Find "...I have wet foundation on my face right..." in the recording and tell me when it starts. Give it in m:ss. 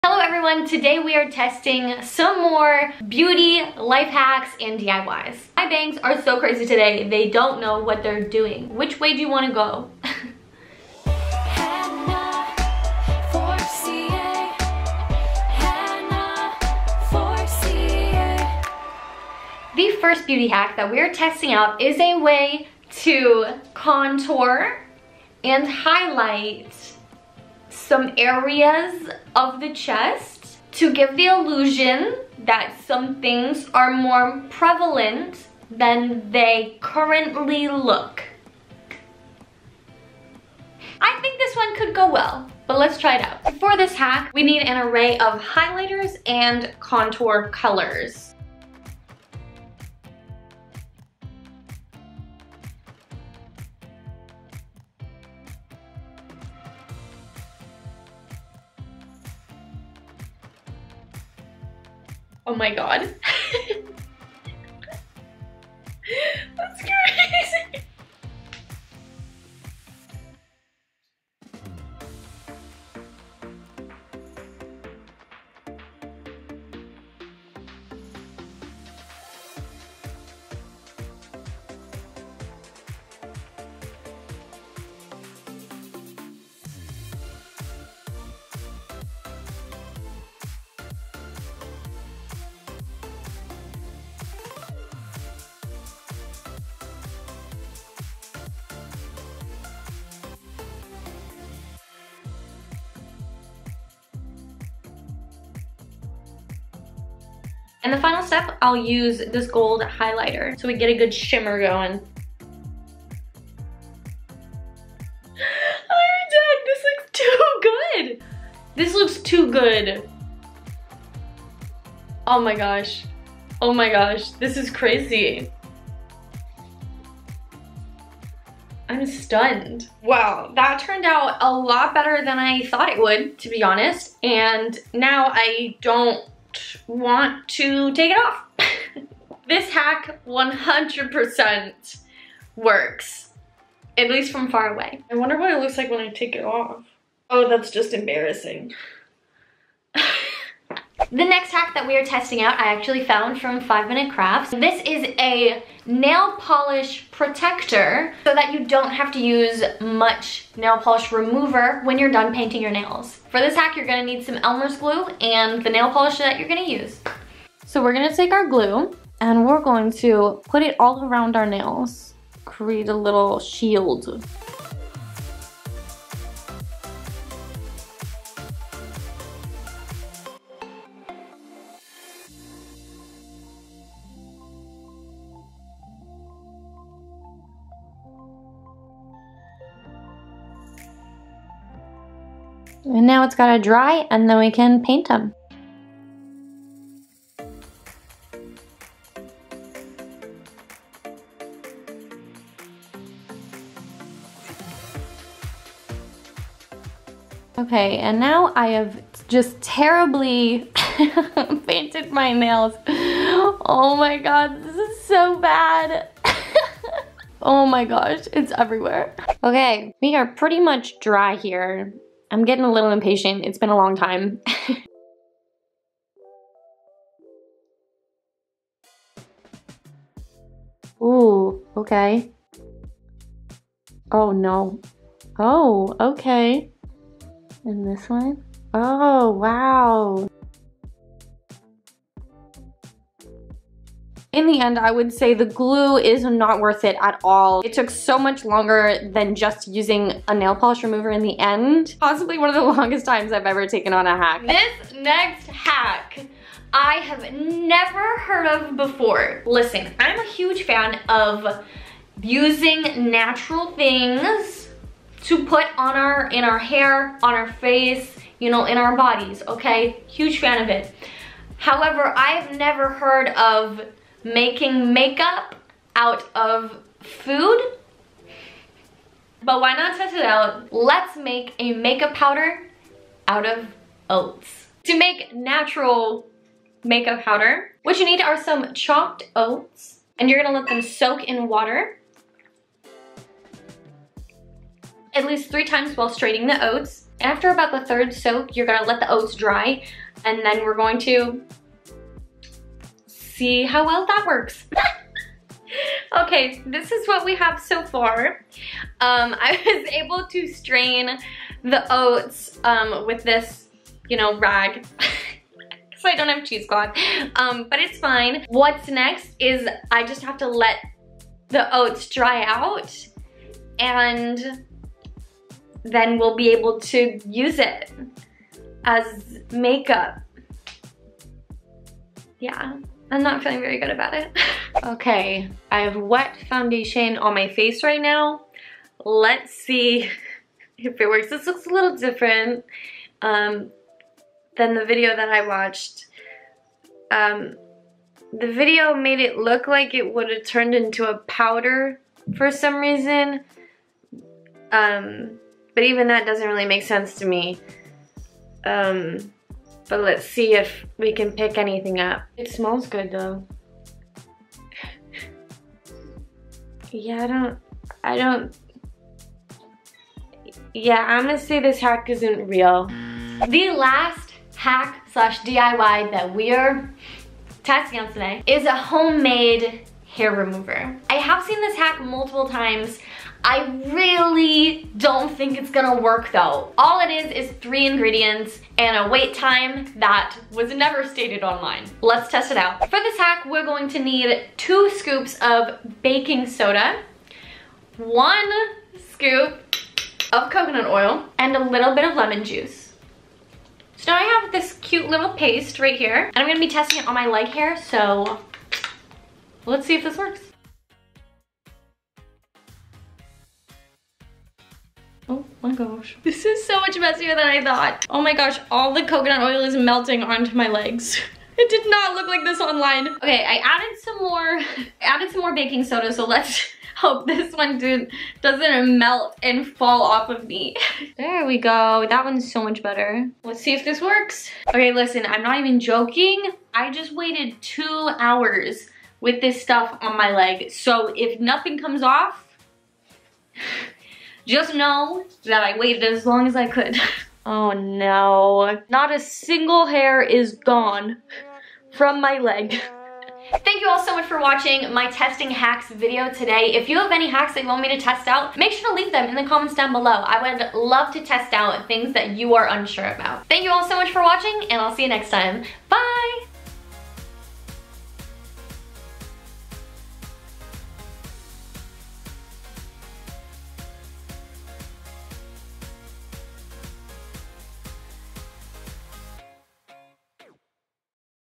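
5:35.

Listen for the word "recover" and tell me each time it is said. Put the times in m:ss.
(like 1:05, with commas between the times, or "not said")
not said.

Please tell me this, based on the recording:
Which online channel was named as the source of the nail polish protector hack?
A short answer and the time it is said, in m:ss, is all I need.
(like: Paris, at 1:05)
5 Minute Crafts, at 2:33.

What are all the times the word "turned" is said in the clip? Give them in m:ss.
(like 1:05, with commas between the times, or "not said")
2:10, 5:50.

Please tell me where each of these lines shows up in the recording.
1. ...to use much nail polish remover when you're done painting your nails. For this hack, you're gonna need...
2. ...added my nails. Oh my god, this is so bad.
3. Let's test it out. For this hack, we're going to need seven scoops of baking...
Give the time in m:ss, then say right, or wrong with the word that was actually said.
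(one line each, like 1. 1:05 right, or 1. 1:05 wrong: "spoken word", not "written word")
1. 2:39 right
2. 3:31 wrong: "painted", not "added"
3. 6:32 wrong: "two", not "seven".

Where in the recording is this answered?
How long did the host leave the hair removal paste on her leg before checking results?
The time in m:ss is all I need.
7:17.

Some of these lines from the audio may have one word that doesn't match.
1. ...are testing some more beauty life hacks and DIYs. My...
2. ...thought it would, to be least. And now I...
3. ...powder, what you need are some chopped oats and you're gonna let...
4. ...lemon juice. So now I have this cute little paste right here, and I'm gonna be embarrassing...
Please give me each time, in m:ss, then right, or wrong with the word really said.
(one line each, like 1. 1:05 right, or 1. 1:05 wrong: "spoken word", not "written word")
1. 0:01 right
2. 2:12 wrong: "honest", not "least"
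3. 4:47 right
4. 6:42 wrong: "testing", not "embarrassing".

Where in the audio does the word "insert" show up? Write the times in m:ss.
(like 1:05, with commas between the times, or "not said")
not said.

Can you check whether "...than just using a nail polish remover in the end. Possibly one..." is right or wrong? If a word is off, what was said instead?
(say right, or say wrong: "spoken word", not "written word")
right.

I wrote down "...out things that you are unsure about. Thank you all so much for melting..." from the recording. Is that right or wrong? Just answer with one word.
wrong.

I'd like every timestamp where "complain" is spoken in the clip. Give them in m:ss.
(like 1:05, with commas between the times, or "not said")
not said.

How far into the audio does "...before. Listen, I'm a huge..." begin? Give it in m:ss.
4:18.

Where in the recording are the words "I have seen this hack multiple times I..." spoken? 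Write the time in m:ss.
6:21.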